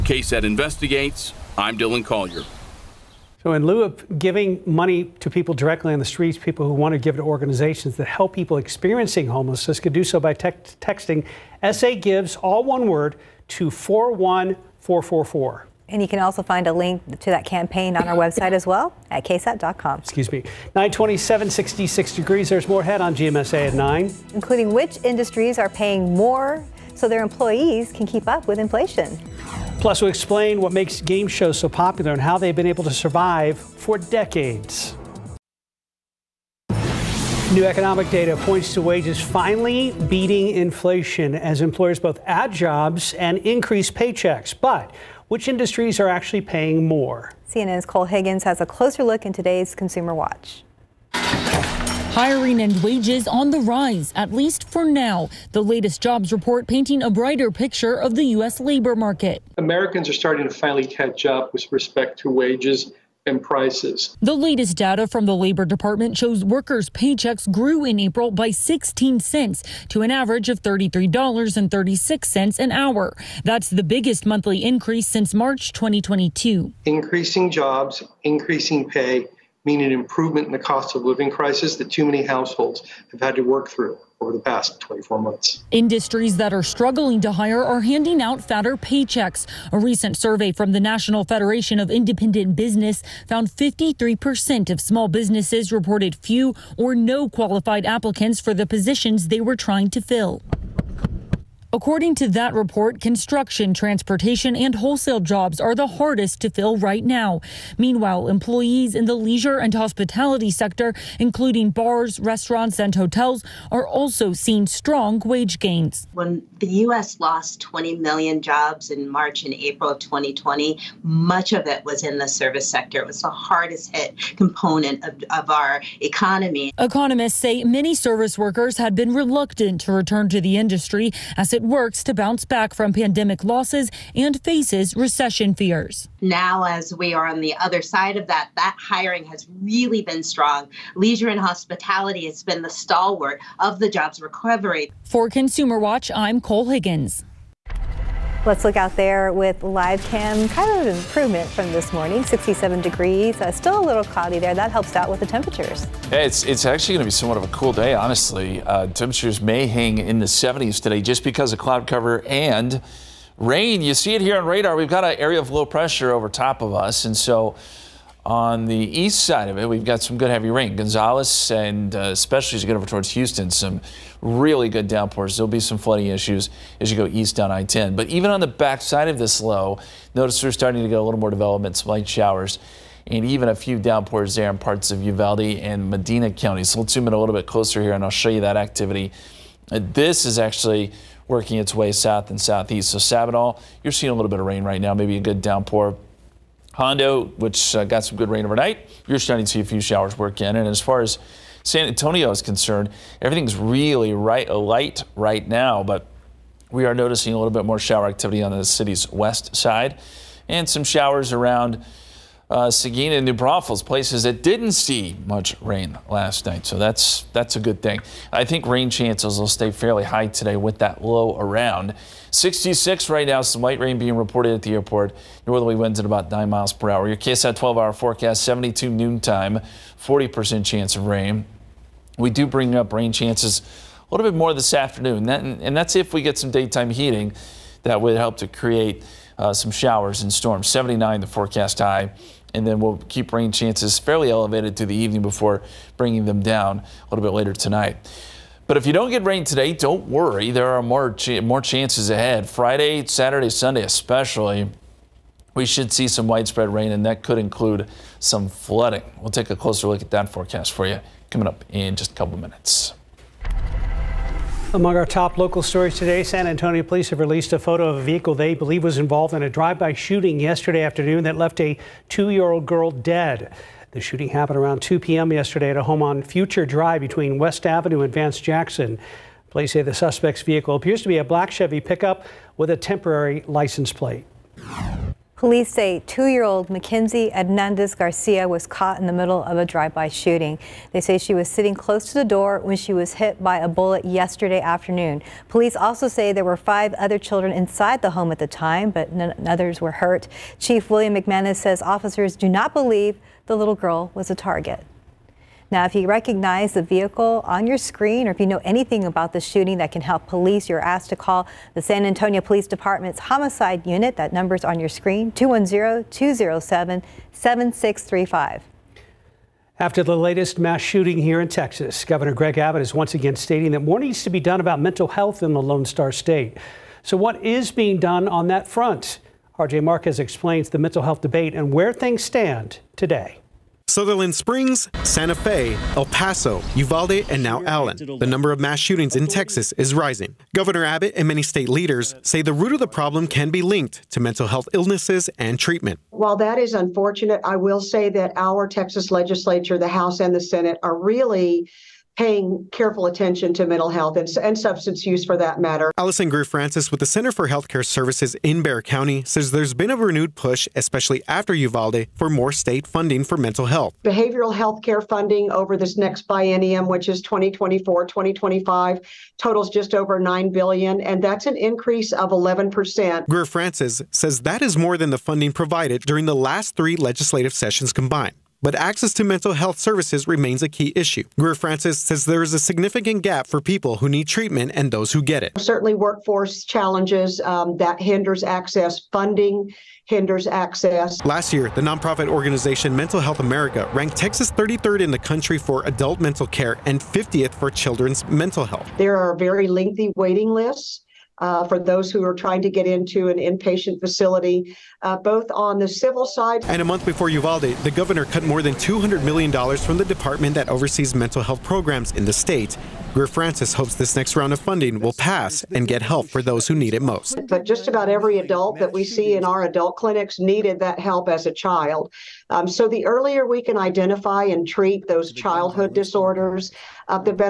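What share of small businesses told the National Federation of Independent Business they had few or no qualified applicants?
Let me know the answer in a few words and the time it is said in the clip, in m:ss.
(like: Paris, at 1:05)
53%, at 1:33.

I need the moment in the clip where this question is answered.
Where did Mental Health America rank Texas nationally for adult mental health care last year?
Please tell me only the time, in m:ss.
6:34.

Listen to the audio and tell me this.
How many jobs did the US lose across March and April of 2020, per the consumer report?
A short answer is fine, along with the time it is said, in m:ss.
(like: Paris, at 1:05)
20 million, at 1:57.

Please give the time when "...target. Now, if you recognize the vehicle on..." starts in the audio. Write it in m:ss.
5:04.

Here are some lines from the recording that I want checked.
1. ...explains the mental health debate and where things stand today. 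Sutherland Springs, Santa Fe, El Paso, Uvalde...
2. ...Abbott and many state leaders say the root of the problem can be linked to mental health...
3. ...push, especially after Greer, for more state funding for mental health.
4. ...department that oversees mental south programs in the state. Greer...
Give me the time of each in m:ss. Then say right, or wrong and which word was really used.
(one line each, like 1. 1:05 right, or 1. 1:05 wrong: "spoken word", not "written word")
1. 5:30 right
2. 5:40 right
3. 6:00 wrong: "Uvalde", not "Greer"
4. 6:50 wrong: "health", not "south".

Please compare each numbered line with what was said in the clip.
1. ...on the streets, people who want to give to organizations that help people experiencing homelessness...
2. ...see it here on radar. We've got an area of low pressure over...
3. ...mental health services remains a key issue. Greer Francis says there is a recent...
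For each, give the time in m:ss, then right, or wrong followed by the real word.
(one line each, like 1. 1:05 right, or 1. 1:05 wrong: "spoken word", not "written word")
1. 0:05 right
2. 2:43 right
3. 6:19 wrong: "significant", not "recent".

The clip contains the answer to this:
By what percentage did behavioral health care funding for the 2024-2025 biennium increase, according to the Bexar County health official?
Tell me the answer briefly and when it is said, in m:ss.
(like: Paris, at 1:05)
11%, at 6:12.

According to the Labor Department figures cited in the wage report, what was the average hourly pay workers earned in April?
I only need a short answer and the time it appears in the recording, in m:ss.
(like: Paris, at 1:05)
$33.36, at 1:10.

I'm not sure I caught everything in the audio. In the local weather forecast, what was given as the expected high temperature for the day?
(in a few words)
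79.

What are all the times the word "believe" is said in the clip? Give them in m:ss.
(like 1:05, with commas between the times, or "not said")
4:28, 5:02.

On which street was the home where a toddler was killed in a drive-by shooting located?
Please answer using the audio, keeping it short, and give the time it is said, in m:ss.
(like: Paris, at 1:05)
Future Drive, at 4:36.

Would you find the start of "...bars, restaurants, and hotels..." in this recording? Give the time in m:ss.
1:51.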